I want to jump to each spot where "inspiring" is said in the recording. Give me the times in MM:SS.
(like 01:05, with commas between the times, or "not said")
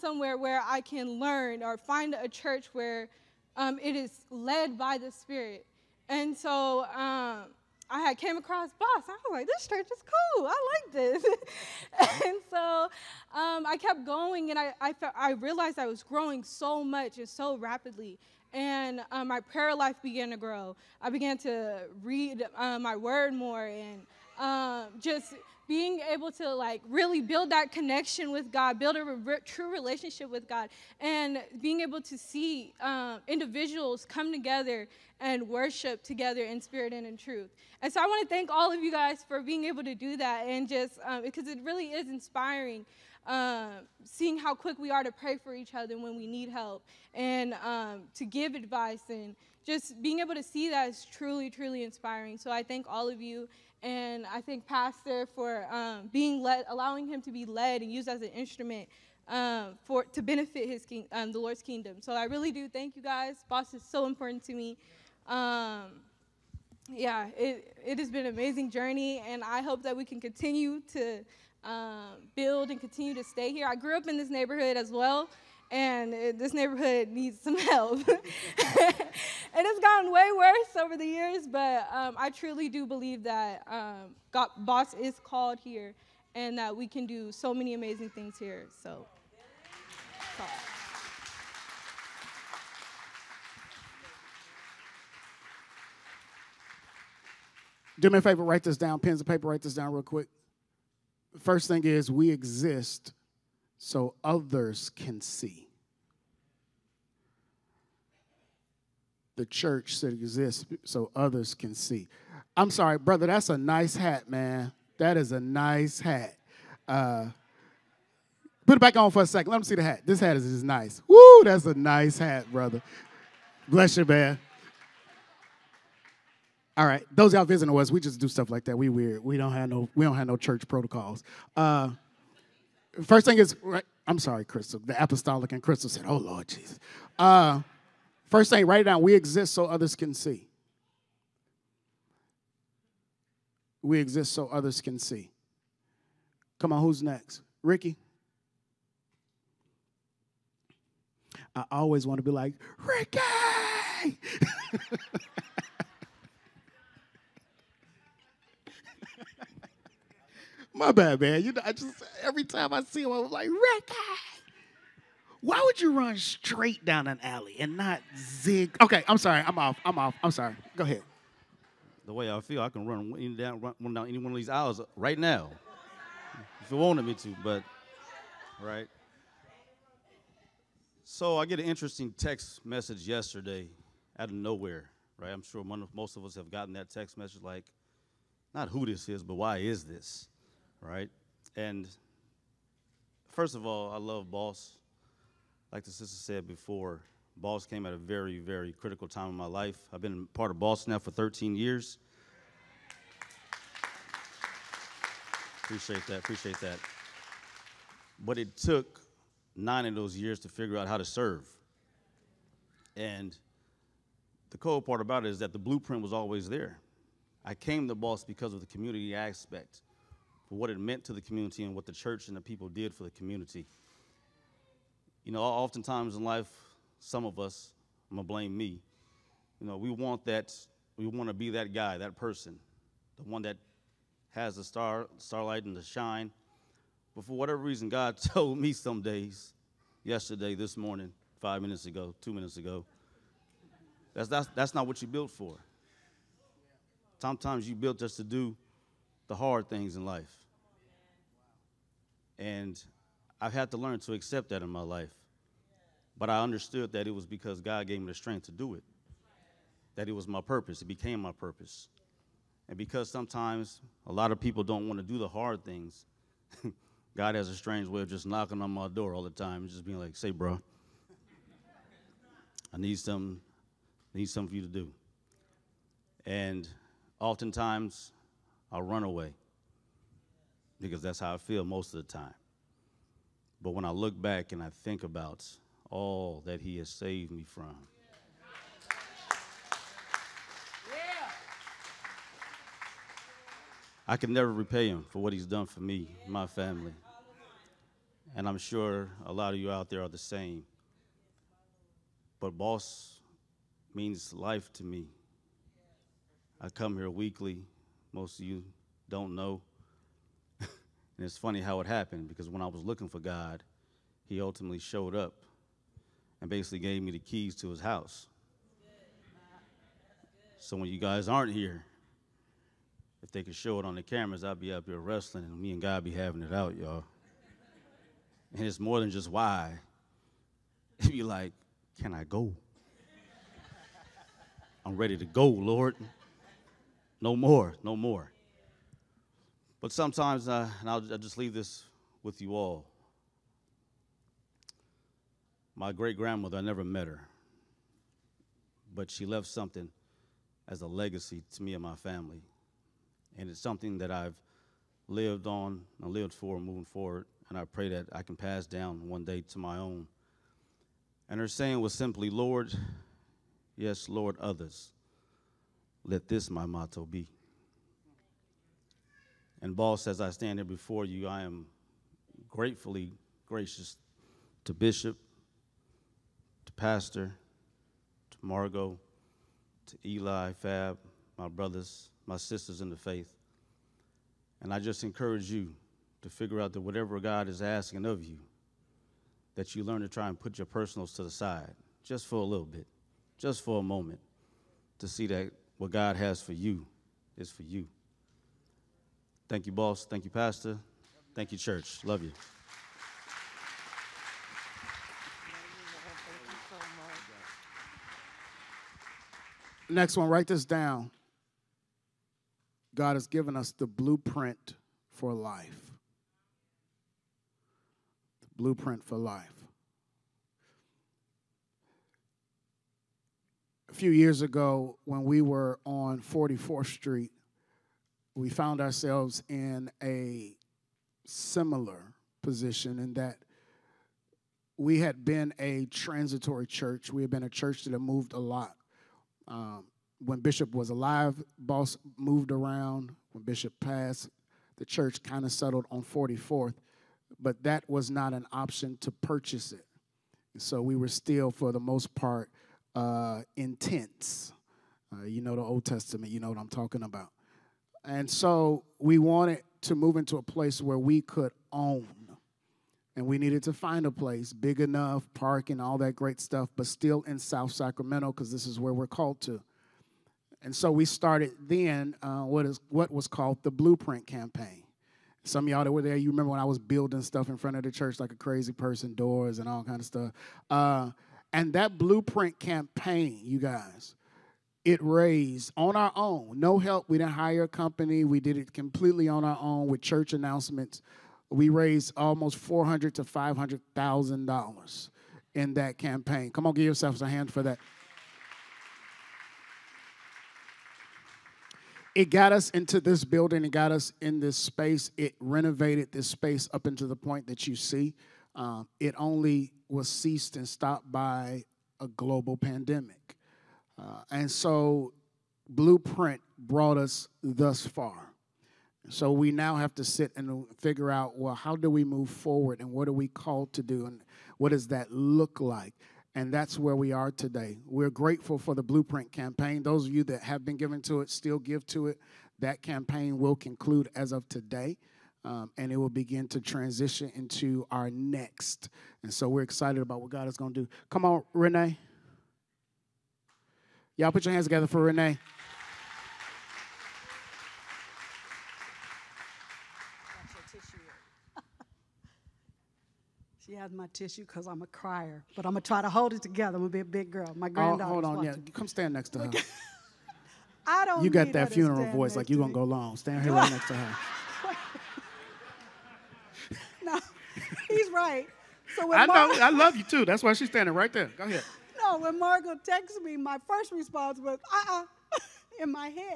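00:42, 00:51.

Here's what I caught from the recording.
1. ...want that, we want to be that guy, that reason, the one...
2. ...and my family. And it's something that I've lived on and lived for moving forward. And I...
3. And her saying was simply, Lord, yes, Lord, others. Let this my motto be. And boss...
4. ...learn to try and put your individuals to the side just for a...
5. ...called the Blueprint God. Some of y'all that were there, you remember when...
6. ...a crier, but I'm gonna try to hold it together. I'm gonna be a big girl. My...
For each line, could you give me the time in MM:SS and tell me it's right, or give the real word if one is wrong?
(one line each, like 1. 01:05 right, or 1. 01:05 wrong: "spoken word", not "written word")
1. 03:49 wrong: "person", not "reason"
2. 05:51 right
3. 06:01 right
4. 06:29 wrong: "personals", not "individuals"
5. 07:53 wrong: "Campaign", not "God"
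6. 09:14 right.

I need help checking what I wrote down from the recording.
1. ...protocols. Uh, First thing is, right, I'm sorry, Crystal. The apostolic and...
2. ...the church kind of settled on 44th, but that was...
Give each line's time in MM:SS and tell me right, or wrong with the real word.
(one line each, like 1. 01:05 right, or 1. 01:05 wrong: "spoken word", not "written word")
1. 02:10 right
2. 07:24 right.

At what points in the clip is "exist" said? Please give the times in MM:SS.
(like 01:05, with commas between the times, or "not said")
01:42, 01:50, 02:19, 02:23.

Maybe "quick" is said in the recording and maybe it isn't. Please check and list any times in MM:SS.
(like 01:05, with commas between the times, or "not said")
00:44, 01:40.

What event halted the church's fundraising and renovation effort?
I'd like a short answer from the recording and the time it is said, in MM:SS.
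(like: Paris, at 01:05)
a global pandemic, at 08:32.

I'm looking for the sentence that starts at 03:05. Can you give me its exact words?
I'm sure most of us have gotten that text message like, not who this is, but why is this?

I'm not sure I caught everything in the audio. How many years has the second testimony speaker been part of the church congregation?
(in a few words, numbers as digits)
13.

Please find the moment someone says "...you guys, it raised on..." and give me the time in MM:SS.
08:03.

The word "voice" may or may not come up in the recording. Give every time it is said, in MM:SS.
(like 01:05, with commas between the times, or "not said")
09:22.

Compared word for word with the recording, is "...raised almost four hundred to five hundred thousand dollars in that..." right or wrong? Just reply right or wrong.
right.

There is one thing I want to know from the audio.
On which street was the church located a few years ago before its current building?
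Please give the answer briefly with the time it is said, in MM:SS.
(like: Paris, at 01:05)
44th Street, at 07:06.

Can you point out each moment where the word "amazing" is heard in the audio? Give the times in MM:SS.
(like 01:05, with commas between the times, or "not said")
01:08, 01:27.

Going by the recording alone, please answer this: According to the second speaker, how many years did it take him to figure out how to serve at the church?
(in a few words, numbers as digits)
9.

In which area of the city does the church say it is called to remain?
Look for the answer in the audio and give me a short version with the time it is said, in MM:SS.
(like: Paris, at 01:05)
South Sacramento, at 07:47.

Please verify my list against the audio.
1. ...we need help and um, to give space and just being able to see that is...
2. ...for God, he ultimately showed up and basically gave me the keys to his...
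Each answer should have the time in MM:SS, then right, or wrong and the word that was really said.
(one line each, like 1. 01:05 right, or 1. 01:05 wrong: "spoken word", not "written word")
1. 00:46 wrong: "advice", not "space"
2. 05:13 right.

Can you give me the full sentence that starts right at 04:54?
I can never repay Him for what He's done for me, my family.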